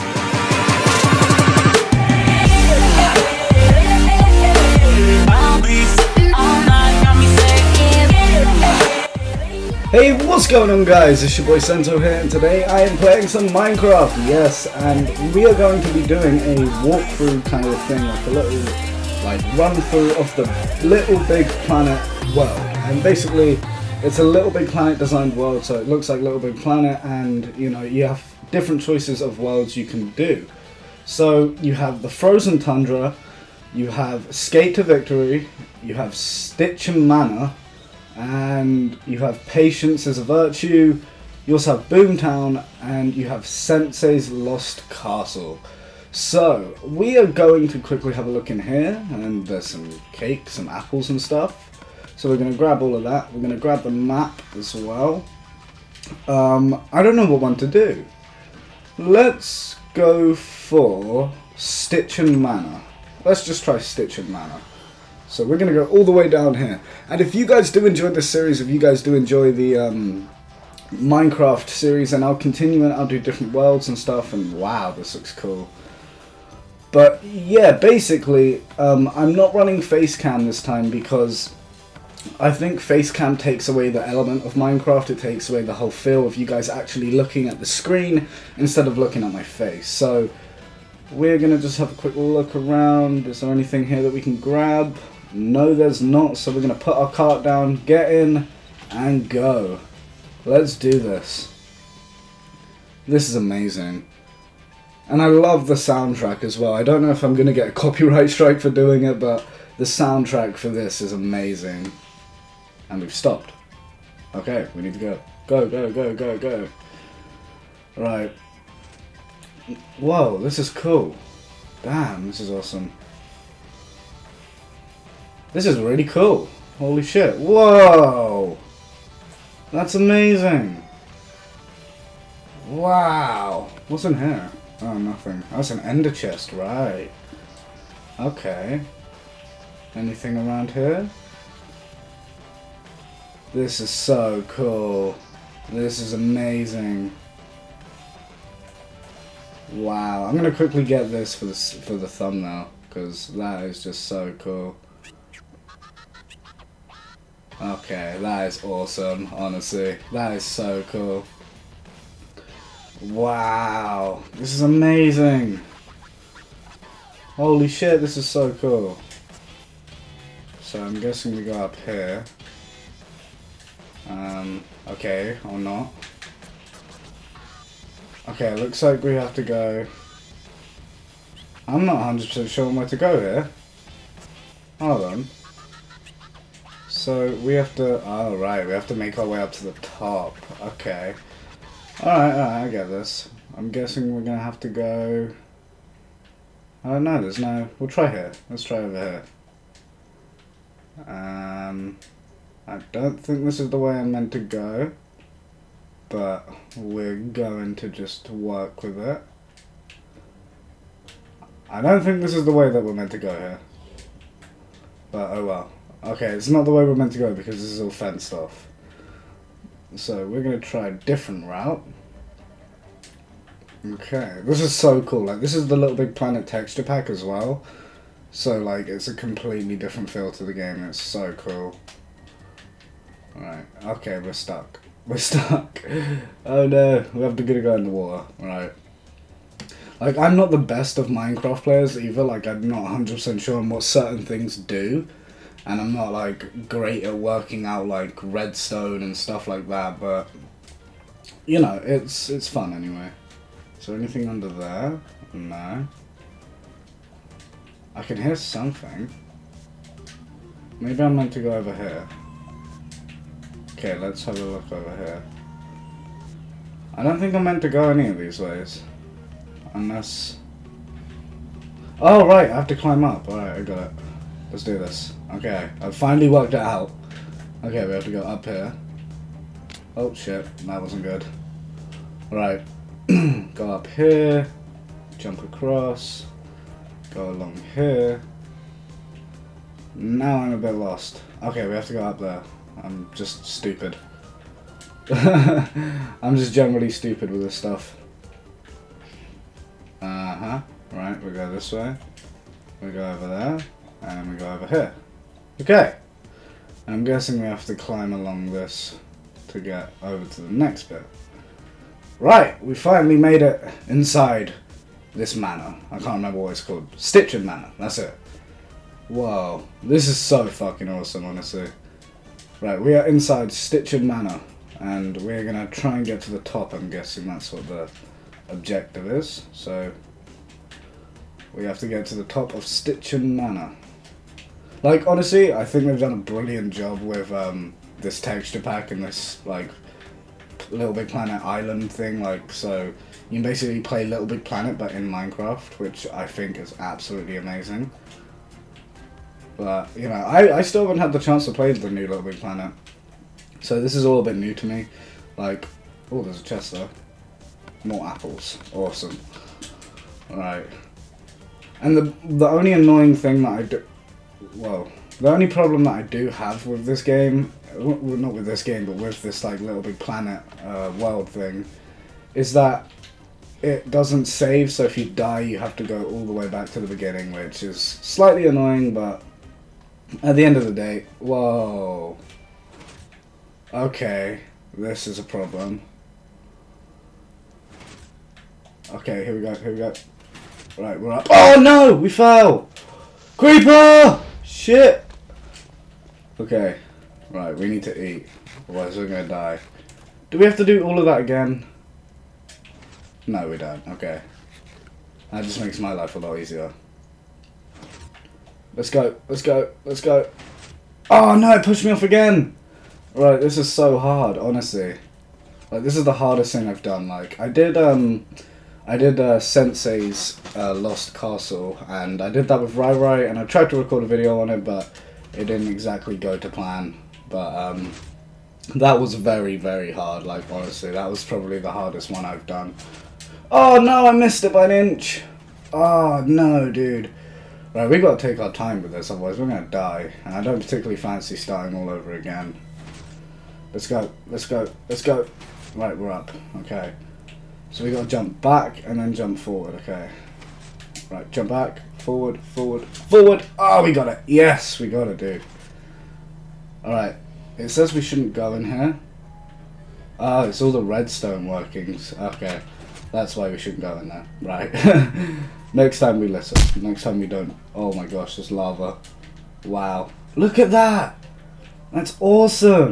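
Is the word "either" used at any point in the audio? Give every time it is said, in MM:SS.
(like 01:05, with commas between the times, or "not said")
04:01.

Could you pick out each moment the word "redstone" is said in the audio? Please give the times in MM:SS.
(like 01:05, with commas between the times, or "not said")
04:08, 07:40.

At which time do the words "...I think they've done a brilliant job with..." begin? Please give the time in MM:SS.
05:35.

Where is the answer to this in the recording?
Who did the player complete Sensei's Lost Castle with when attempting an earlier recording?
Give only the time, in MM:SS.
07:02.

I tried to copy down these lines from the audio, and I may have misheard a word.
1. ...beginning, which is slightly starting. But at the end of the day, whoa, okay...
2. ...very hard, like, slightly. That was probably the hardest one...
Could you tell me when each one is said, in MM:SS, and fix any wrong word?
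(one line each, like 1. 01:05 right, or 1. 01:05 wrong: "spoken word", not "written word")
1. 06:16 wrong: "annoying", not "starting"
2. 07:09 wrong: "honestly", not "slightly".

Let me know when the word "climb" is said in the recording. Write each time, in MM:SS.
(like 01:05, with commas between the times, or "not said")
04:32, 05:07.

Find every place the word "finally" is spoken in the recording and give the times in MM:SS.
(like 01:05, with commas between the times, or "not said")
04:35, 05:12.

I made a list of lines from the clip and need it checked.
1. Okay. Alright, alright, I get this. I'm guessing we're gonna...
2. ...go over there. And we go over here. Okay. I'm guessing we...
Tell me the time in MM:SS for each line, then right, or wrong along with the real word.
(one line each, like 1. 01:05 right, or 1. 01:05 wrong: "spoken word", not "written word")
1. 03:10 right
2. 05:02 right.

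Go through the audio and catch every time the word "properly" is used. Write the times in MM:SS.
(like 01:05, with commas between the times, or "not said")
not said.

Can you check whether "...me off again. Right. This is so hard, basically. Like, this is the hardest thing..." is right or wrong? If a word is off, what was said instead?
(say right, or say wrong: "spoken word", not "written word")
wrong: "honestly", not "basically".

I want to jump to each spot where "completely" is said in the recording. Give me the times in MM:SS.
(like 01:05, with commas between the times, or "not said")
03:49.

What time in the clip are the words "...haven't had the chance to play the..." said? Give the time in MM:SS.
05:50.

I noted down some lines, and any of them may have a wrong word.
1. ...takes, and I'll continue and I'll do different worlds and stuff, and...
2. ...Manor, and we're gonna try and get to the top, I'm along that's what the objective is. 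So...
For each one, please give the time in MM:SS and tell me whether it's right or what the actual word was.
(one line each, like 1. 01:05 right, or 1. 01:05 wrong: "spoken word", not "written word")
1. 01:11 wrong: "series", not "takes"
2. 05:24 wrong: "guessing", not "along".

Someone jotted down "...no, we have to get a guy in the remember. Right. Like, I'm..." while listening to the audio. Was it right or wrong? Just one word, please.
wrong.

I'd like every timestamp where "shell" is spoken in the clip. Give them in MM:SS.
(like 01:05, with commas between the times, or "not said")
not said.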